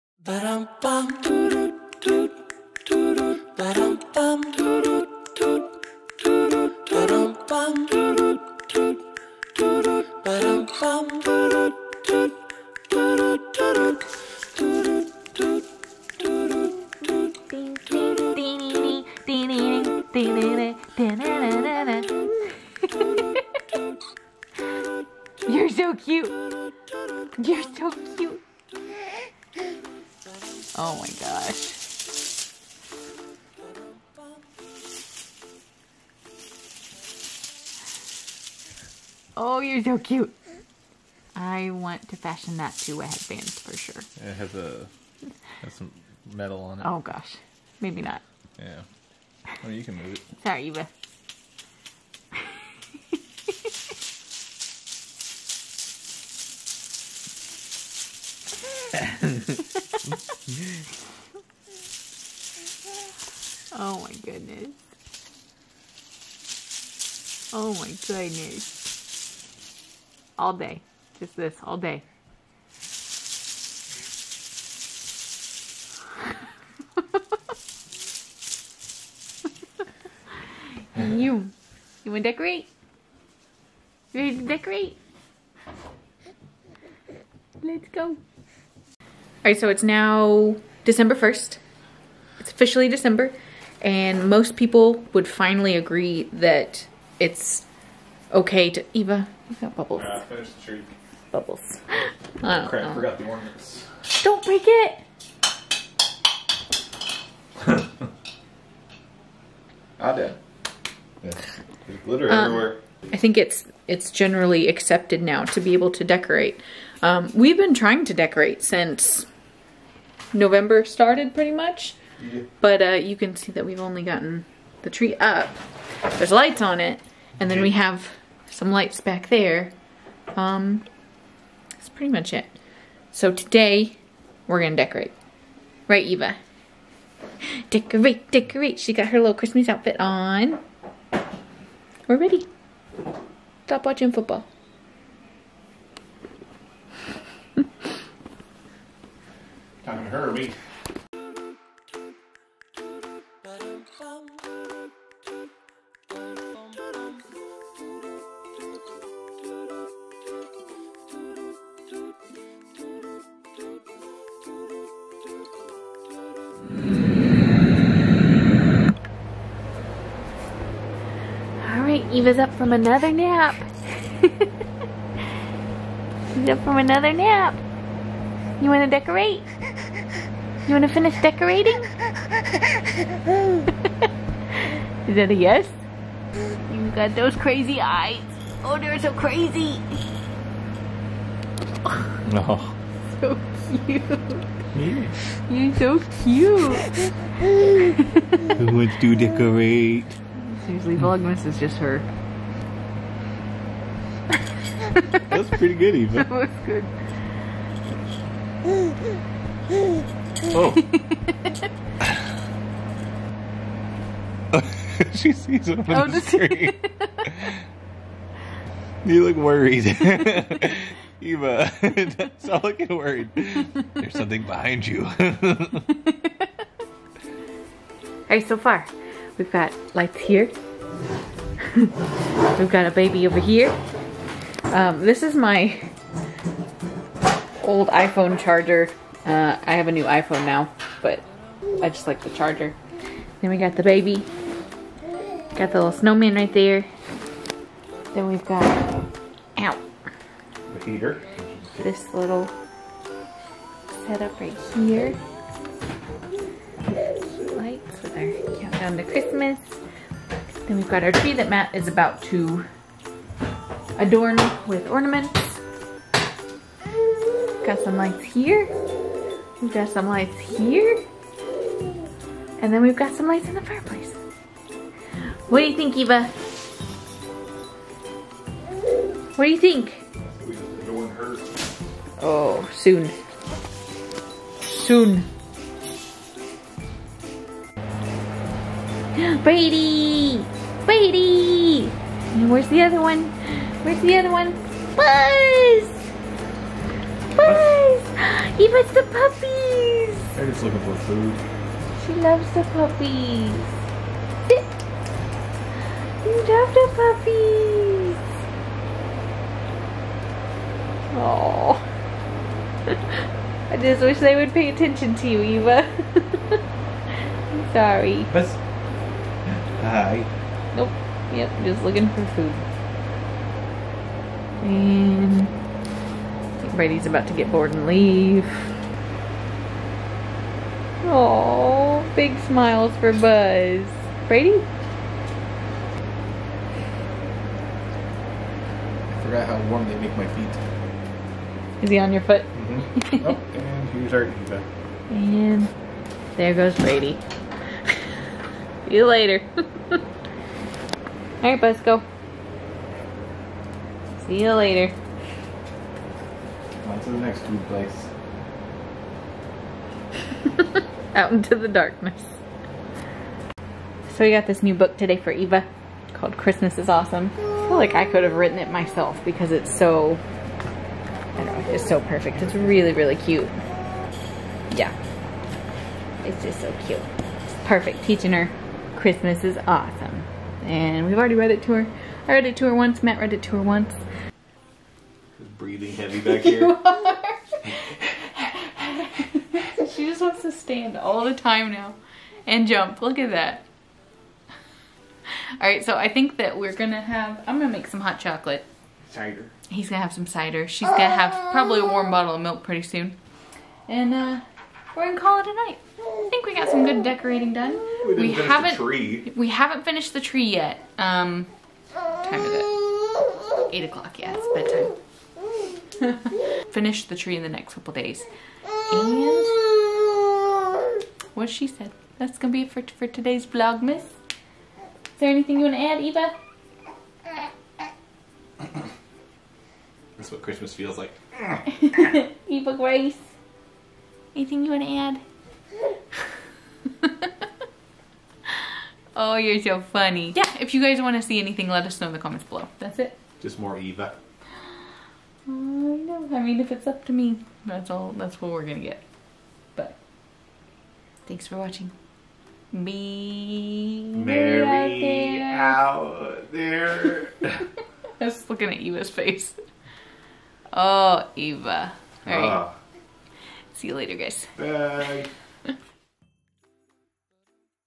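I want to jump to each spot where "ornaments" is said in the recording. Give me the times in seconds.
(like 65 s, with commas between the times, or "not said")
103 s, 264 s.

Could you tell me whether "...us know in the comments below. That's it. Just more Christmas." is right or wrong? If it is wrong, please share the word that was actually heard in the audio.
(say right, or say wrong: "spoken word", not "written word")
wrong: "Eva", not "Christmas".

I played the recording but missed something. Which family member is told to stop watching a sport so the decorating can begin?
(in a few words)
Herbie.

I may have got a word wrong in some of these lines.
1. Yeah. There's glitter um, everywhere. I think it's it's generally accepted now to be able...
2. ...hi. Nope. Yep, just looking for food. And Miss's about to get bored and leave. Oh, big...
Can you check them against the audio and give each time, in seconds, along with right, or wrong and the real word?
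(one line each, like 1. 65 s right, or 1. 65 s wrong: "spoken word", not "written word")
1. 111 s right
2. 319 s wrong: "Brady", not "Miss".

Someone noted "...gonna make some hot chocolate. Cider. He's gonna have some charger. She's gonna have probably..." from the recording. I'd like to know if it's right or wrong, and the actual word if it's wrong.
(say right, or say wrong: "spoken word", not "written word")
wrong: "cider", not "charger".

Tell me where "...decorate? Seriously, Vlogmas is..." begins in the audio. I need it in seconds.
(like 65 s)
199 s.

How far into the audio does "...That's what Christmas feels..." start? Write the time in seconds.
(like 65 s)
430 s.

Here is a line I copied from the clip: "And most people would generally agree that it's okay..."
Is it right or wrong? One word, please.
wrong.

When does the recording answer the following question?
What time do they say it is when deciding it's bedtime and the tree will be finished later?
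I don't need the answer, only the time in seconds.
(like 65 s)
413 s.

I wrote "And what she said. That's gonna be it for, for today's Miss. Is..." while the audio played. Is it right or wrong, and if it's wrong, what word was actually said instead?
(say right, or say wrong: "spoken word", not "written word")
right.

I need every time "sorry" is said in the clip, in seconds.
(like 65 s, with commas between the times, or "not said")
50 s, 317 s.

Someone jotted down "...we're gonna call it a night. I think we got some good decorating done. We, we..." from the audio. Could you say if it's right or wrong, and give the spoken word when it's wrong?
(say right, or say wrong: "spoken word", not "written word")
right.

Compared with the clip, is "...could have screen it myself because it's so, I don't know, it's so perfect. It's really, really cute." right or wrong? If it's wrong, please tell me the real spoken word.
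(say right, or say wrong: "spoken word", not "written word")
wrong: "written", not "screen".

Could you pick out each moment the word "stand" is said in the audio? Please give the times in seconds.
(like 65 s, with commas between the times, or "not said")
390 s.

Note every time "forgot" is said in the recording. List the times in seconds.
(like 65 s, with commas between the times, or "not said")
102 s, 339 s.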